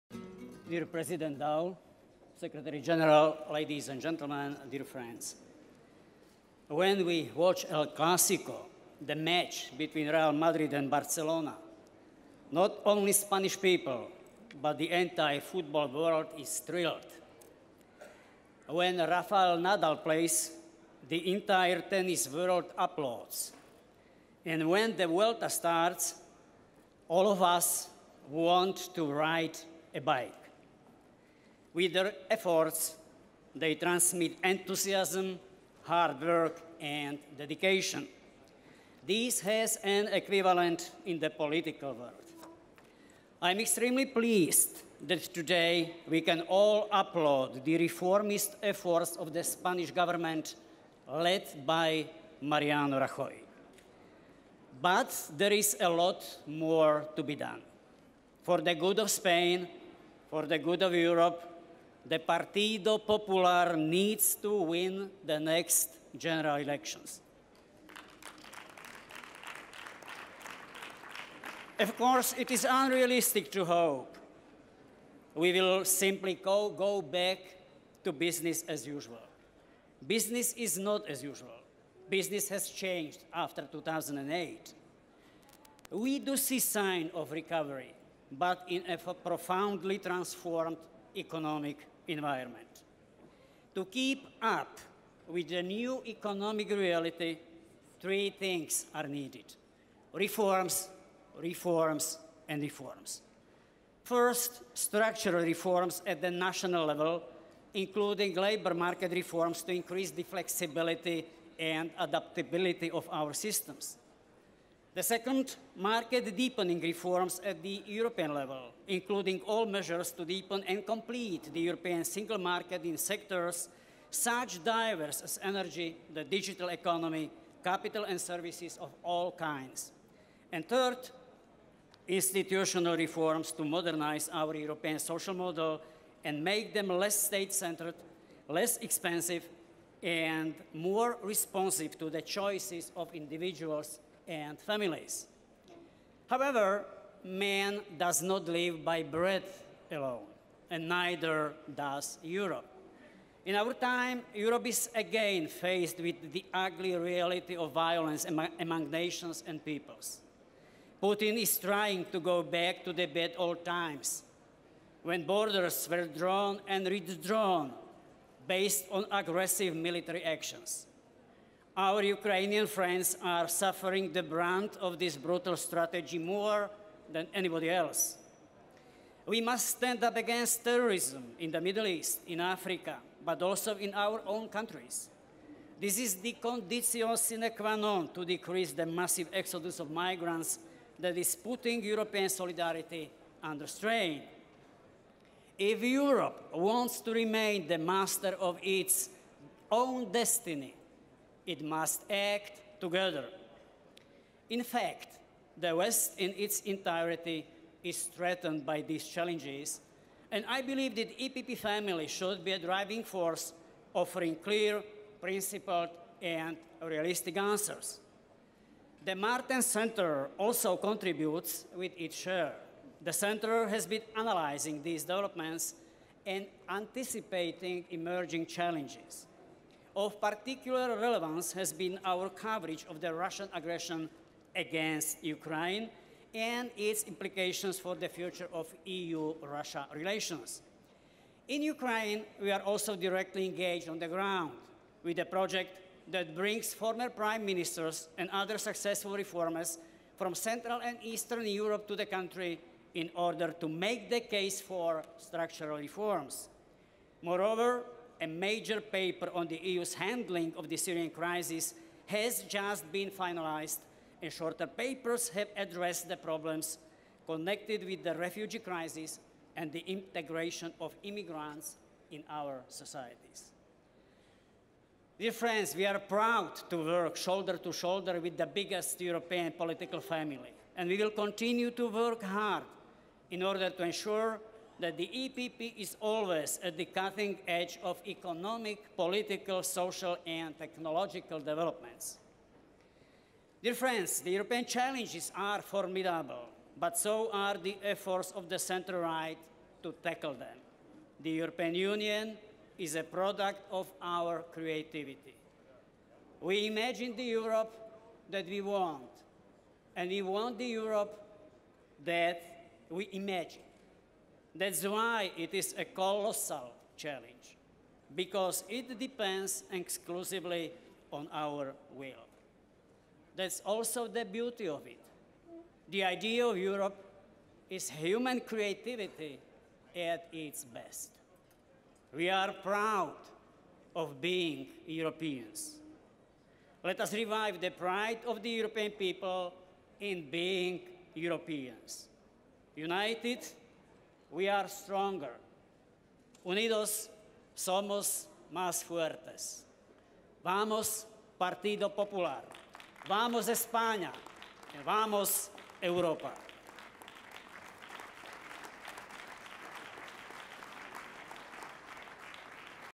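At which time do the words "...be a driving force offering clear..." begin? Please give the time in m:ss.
3:32.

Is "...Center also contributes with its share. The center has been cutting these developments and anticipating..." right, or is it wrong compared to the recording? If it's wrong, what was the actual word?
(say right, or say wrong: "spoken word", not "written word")
wrong: "analyzing", not "cutting".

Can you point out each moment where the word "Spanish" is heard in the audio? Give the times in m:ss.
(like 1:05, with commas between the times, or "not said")
0:13, 0:49.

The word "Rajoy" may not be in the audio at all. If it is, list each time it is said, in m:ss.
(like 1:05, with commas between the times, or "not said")
0:52.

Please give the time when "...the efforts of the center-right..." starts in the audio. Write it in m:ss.
4:57.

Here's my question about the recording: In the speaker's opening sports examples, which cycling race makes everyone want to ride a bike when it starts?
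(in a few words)
the Vuelta.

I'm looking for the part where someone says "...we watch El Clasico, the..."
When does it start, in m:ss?
0:07.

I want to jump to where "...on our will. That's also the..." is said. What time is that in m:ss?
5:21.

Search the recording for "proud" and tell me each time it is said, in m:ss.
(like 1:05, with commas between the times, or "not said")
4:35, 5:32.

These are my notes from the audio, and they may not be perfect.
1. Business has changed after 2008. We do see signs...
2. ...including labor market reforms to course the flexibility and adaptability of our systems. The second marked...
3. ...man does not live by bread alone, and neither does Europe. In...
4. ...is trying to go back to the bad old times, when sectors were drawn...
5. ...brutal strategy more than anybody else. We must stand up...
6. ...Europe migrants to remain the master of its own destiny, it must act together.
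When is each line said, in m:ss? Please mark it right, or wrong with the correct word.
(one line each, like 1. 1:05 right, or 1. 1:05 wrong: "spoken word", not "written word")
1. 1:22 right
2. 1:47 wrong: "increase", not "course"
3. 2:27 right
4. 2:41 wrong: "borders", not "sectors"
5. 2:55 right
6. 3:15 wrong: "wants", not "migrants".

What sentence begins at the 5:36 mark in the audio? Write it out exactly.
Let us revive the pride of the European people in being Europeans.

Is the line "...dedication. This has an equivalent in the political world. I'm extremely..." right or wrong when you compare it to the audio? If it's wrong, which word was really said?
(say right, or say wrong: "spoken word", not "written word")
right.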